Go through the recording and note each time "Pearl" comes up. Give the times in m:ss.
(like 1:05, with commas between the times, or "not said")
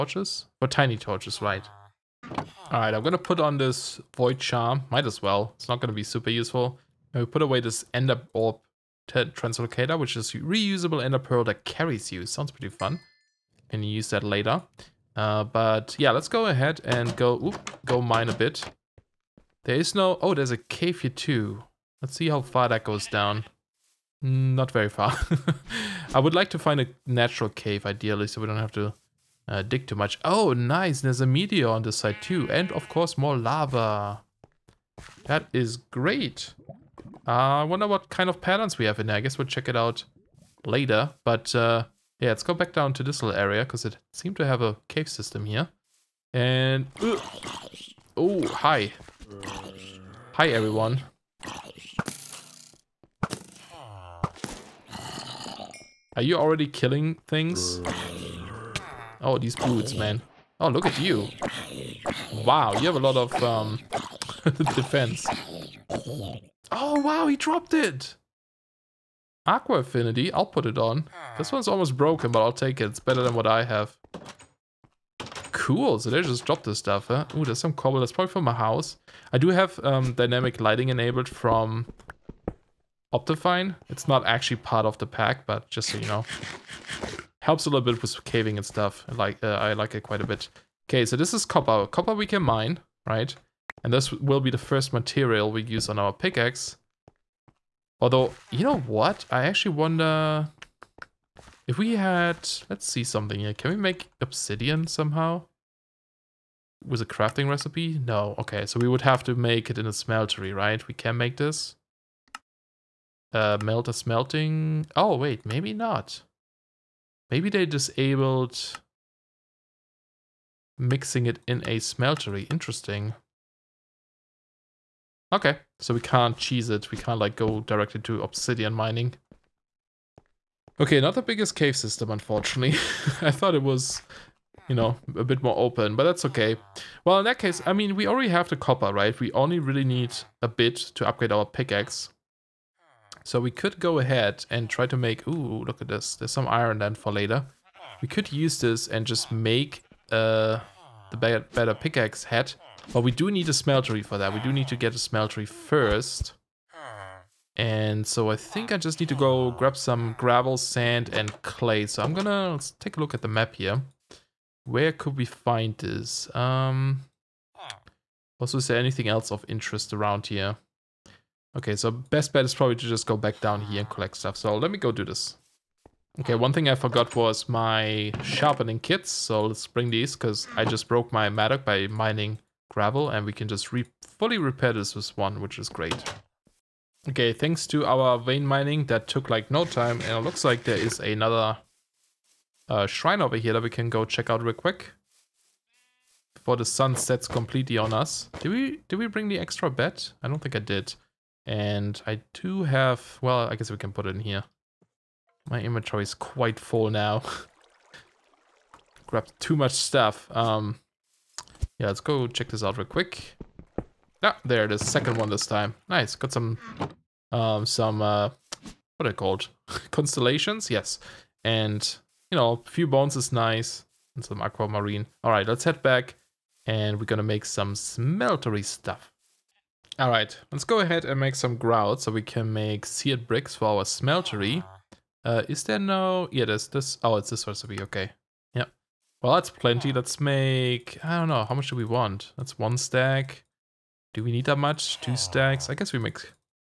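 0:11.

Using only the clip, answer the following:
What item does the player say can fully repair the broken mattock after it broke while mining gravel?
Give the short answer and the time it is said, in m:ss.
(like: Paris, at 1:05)
Sharpening kits, at 2:58.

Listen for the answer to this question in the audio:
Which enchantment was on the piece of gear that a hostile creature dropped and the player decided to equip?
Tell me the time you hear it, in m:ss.
1:09.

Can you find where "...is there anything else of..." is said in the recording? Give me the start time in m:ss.
2:48.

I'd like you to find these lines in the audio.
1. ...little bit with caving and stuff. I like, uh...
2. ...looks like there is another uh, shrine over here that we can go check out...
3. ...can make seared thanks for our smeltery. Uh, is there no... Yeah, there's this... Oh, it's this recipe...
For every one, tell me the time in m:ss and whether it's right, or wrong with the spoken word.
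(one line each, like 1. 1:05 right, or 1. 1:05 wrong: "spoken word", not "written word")
1. 1:27 right
2. 3:10 right
3. 3:52 wrong: "bricks", not "thanks".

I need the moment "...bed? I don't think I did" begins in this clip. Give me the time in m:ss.
3:19.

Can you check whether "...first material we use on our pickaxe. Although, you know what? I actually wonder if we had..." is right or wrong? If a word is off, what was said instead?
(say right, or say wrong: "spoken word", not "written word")
right.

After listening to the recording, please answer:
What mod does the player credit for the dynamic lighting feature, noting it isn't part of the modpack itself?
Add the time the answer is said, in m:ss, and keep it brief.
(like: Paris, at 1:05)
Optifine, at 1:23.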